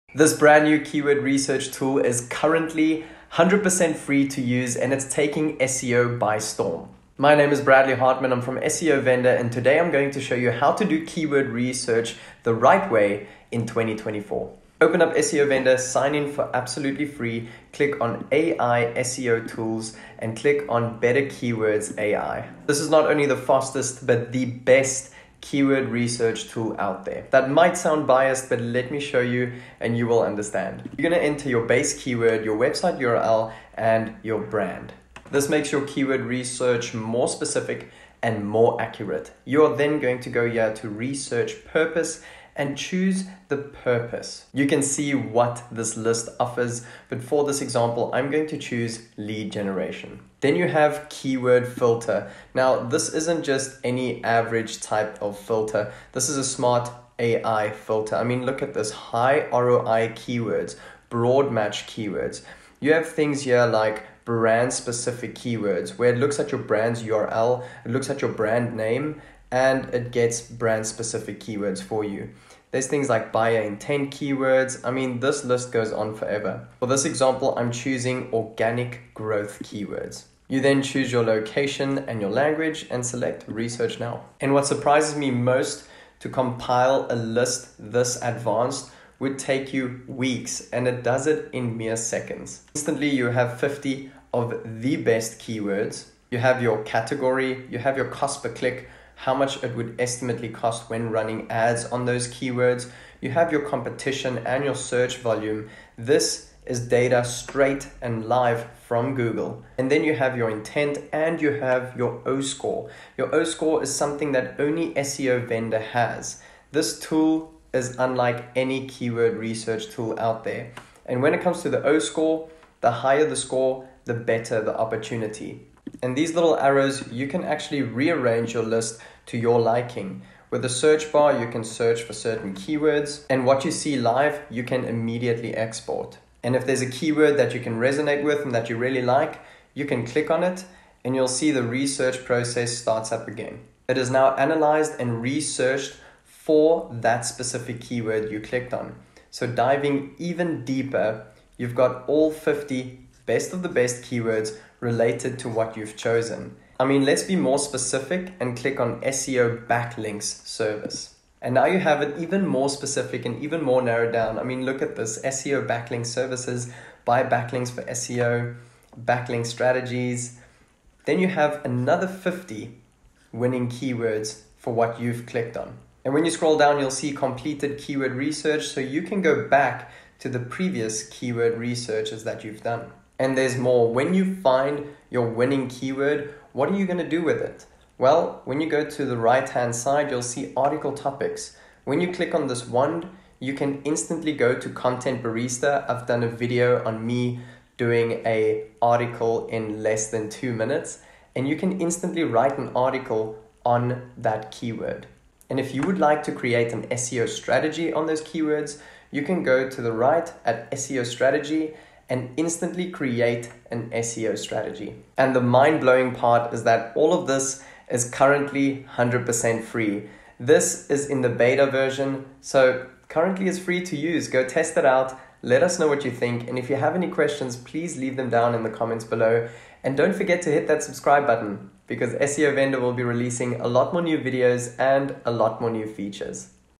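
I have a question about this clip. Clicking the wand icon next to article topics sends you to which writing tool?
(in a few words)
Content Barista.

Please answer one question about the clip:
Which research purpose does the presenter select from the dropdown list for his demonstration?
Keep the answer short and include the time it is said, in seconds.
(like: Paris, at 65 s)
lead generation, at 49 s.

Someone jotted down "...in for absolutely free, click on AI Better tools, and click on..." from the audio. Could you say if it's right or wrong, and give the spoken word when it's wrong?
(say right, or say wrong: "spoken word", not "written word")
wrong: "SEO", not "Better".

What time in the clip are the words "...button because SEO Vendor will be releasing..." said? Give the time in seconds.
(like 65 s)
231 s.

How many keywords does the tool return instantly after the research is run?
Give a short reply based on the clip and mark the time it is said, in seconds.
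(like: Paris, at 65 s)
50, at 93 s.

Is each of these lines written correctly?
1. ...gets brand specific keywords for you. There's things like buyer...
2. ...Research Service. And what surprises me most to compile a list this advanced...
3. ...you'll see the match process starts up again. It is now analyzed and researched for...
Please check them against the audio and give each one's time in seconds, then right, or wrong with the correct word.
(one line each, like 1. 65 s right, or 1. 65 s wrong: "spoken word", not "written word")
1. 70 s right
2. 83 s wrong: "Now", not "Service"
3. 141 s wrong: "research", not "match".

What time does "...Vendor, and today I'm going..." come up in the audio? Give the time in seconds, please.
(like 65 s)
9 s.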